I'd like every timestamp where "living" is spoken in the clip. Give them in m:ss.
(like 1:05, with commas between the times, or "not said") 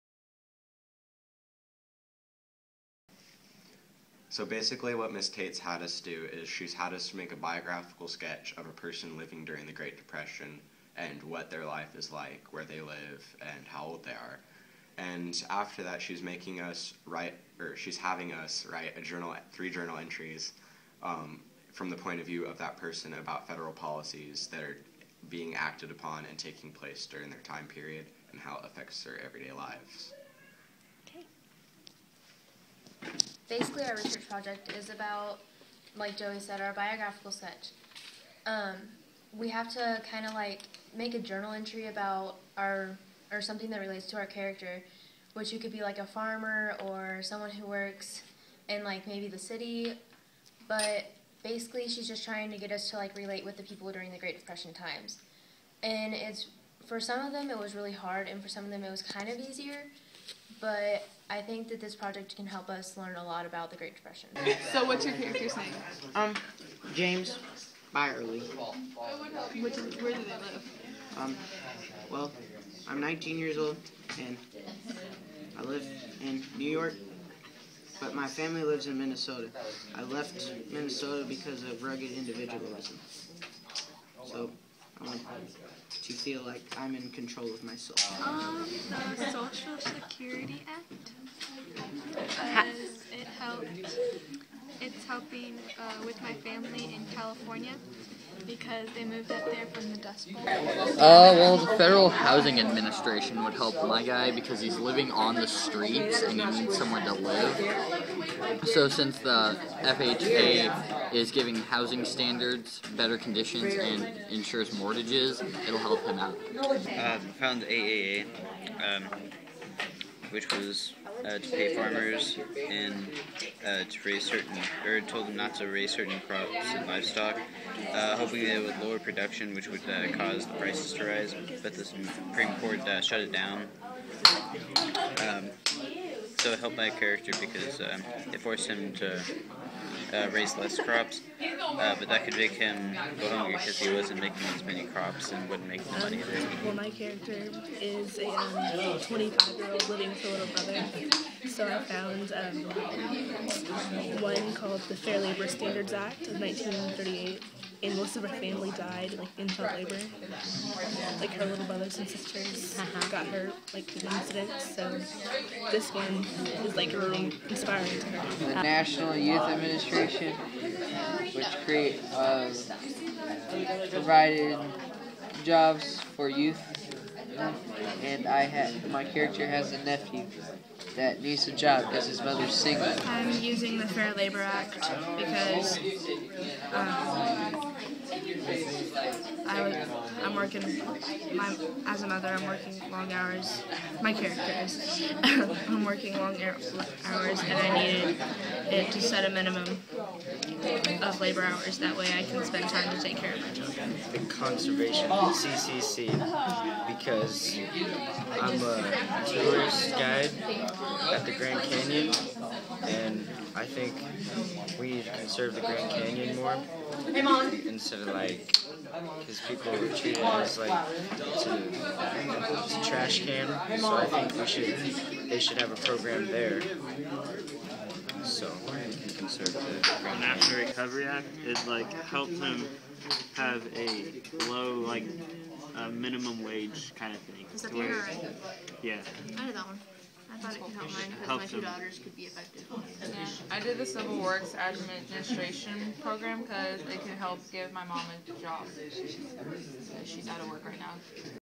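0:09, 1:44, 2:29.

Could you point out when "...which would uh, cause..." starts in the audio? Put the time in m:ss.
2:09.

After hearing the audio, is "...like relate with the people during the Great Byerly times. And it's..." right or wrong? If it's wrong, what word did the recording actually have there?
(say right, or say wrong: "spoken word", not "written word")
wrong: "Depression", not "Byerly".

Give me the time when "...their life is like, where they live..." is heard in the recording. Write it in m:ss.
0:11.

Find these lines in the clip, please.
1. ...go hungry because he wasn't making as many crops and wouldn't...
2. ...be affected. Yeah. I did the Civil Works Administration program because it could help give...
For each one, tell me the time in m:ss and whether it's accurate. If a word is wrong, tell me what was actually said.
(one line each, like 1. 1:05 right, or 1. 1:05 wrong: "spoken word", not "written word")
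1. 2:23 right
2. 4:02 right.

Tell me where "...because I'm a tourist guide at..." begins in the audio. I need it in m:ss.
3:26.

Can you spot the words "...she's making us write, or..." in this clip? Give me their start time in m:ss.
0:16.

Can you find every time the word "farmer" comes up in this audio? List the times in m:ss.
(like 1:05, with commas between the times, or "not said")
0:46, 2:01.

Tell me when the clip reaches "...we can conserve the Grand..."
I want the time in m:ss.
3:48.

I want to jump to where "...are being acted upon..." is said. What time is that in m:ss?
0:24.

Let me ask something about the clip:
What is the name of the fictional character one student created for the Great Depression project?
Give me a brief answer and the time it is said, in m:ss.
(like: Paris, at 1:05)
James Byerly, at 1:06.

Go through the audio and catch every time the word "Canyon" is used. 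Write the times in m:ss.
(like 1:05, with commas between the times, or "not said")
3:31, 3:35.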